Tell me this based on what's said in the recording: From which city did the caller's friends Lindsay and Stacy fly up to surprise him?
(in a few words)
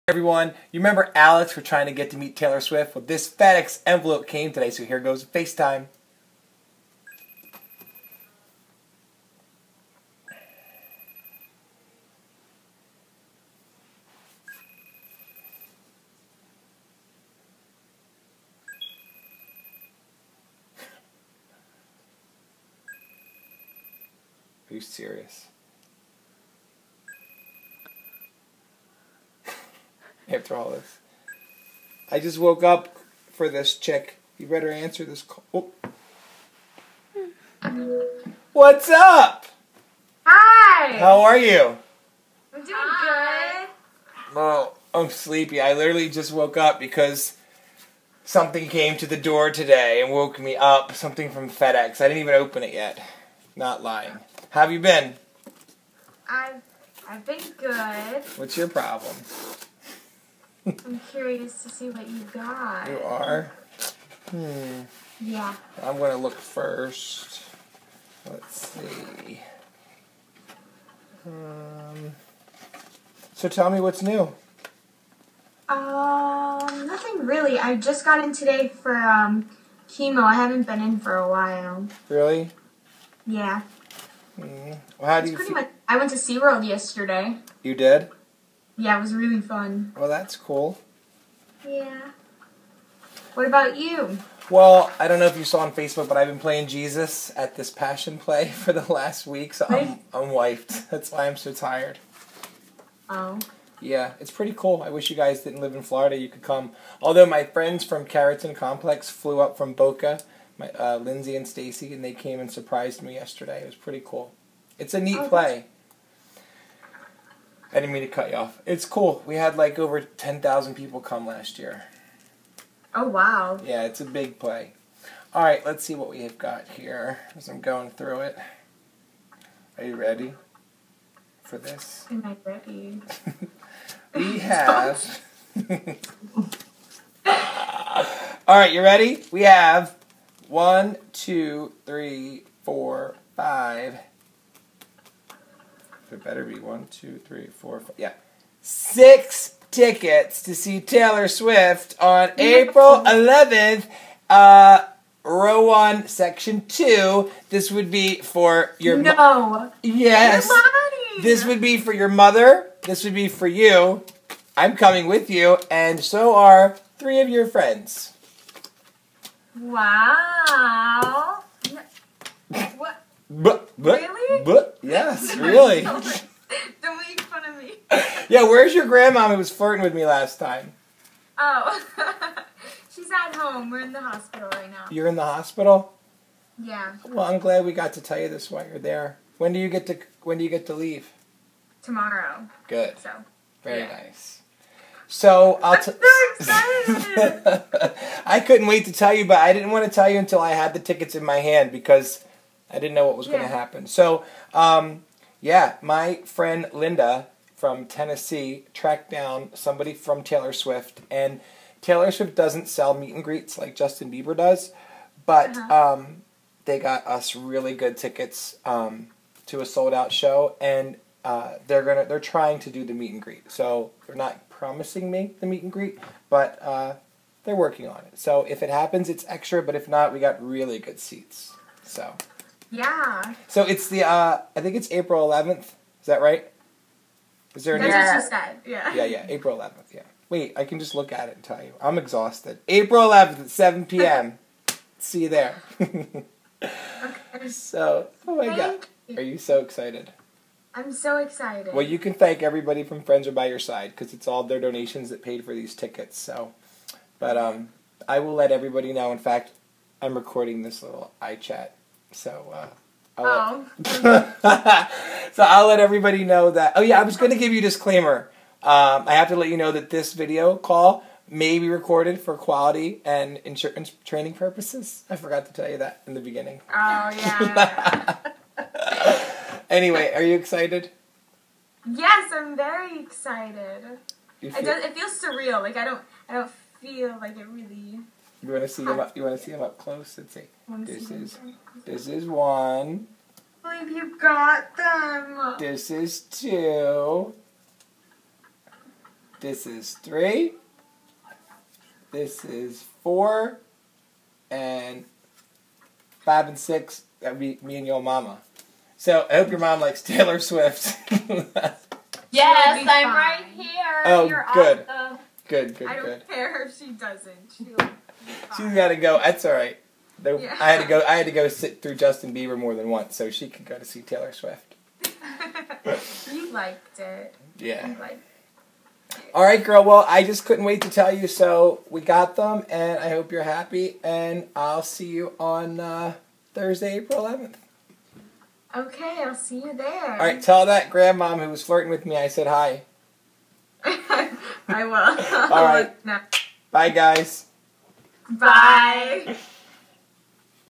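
Boca.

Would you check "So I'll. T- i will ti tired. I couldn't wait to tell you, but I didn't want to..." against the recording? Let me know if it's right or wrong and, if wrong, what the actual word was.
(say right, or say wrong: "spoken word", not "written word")
wrong: "excited", not "tired".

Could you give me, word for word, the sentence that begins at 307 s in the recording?
That'd be me and your mama.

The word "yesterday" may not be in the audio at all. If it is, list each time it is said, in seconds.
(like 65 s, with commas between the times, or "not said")
86 s, 113 s.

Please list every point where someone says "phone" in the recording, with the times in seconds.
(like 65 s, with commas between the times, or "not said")
not said.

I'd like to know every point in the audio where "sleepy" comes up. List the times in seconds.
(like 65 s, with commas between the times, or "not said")
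45 s.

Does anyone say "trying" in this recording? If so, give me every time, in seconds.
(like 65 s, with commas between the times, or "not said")
1 s, 222 s.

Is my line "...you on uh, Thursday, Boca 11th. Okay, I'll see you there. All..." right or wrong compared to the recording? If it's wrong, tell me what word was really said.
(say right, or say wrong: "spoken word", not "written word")
wrong: "April", not "Boca".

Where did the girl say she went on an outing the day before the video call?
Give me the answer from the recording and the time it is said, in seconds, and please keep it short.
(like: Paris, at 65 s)
SeaWorld, at 86 s.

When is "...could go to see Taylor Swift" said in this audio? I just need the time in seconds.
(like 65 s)
323 s.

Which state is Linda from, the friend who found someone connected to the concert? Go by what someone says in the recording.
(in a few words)
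Tennessee.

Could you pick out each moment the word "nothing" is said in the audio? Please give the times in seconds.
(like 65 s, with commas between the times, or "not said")
76 s.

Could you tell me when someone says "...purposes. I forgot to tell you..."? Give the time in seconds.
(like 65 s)
274 s.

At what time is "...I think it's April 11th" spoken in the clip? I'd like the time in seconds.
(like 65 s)
234 s.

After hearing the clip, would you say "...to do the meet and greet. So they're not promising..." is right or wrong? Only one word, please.
right.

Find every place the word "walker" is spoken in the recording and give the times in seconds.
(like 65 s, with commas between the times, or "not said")
not said.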